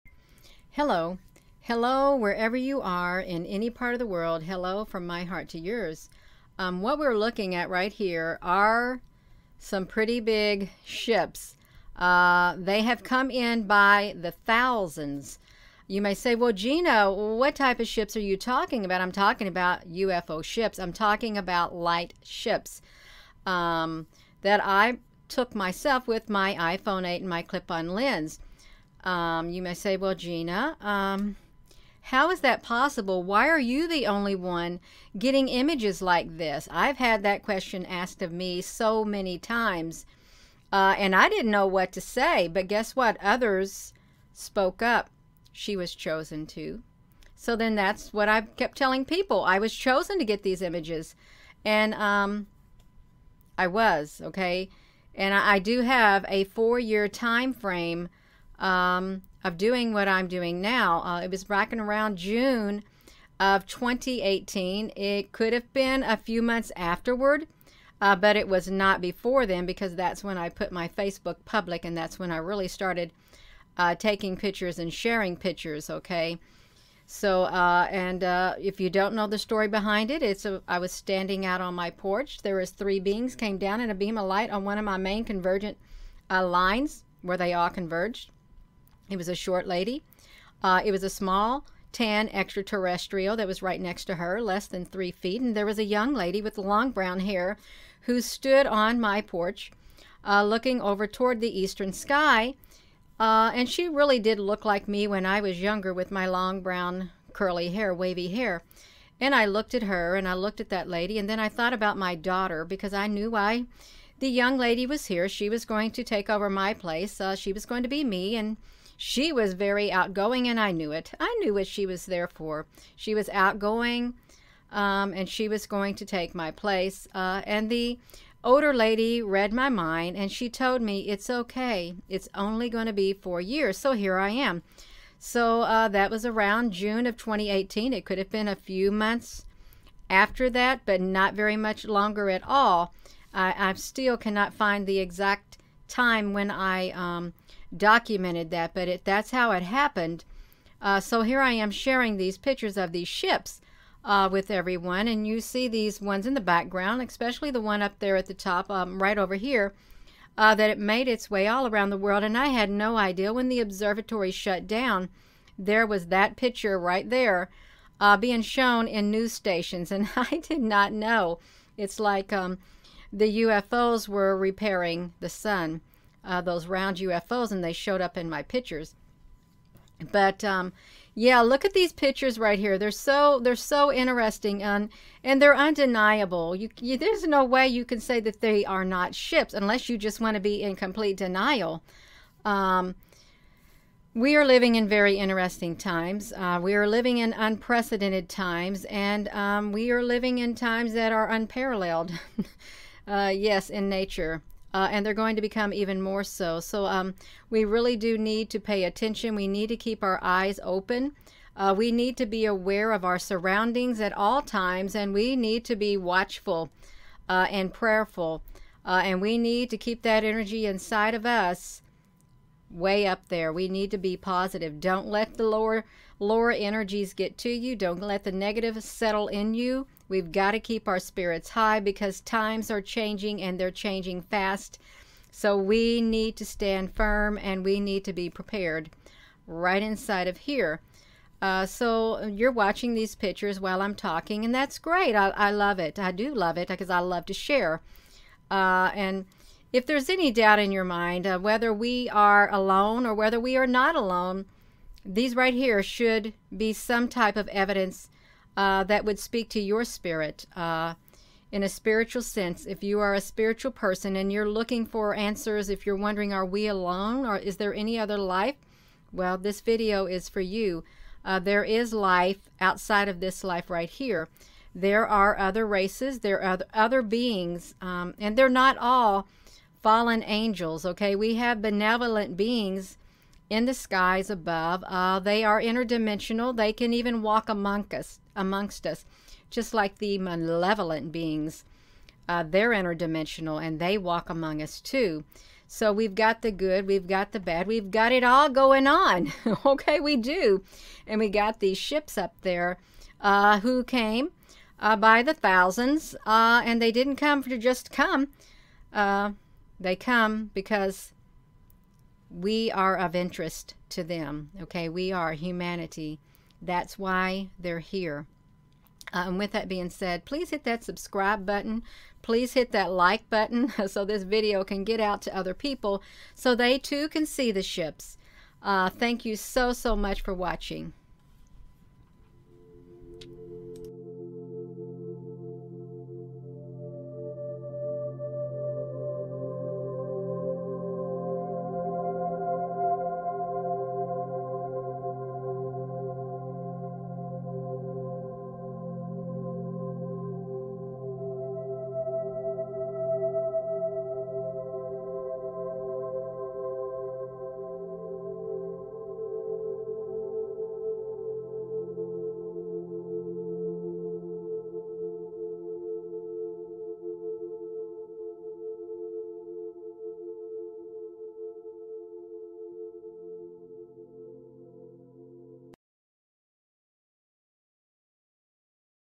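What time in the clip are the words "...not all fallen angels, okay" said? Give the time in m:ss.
4:38.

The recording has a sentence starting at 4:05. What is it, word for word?
I do love it because I love to share.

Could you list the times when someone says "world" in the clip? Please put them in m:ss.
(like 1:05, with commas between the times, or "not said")
0:04, 2:41.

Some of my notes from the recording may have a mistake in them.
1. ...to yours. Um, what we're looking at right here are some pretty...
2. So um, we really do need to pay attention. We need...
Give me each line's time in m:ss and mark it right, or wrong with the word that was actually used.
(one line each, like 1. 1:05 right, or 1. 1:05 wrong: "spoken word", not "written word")
1. 0:05 right
2. 3:26 right.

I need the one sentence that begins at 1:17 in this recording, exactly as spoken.
So, uh, and uh, if you don't know the story behind it, it's a, I was standing out on my porch.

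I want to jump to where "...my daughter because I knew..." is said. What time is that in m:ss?
1:51.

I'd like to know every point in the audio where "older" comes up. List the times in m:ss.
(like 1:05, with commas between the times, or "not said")
2:08.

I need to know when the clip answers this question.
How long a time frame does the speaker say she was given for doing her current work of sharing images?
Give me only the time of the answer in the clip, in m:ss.
0:56.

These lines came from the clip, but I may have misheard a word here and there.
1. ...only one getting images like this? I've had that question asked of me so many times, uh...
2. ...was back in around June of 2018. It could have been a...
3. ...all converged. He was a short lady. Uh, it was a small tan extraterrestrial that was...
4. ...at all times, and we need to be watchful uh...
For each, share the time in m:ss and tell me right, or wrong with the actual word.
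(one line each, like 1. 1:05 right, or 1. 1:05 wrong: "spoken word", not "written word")
1. 0:34 right
2. 1:01 right
3. 1:27 right
4. 3:33 right.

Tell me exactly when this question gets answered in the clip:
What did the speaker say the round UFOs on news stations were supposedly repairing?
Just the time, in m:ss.
2:55.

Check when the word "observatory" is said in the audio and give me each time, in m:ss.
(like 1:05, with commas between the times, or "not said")
2:43.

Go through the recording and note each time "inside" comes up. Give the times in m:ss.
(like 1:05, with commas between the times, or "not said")
3:40, 3:59.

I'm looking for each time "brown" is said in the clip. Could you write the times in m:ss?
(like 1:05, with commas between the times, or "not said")
1:36, 1:46.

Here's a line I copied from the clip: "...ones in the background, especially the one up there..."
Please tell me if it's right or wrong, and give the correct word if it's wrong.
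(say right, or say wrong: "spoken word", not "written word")
right.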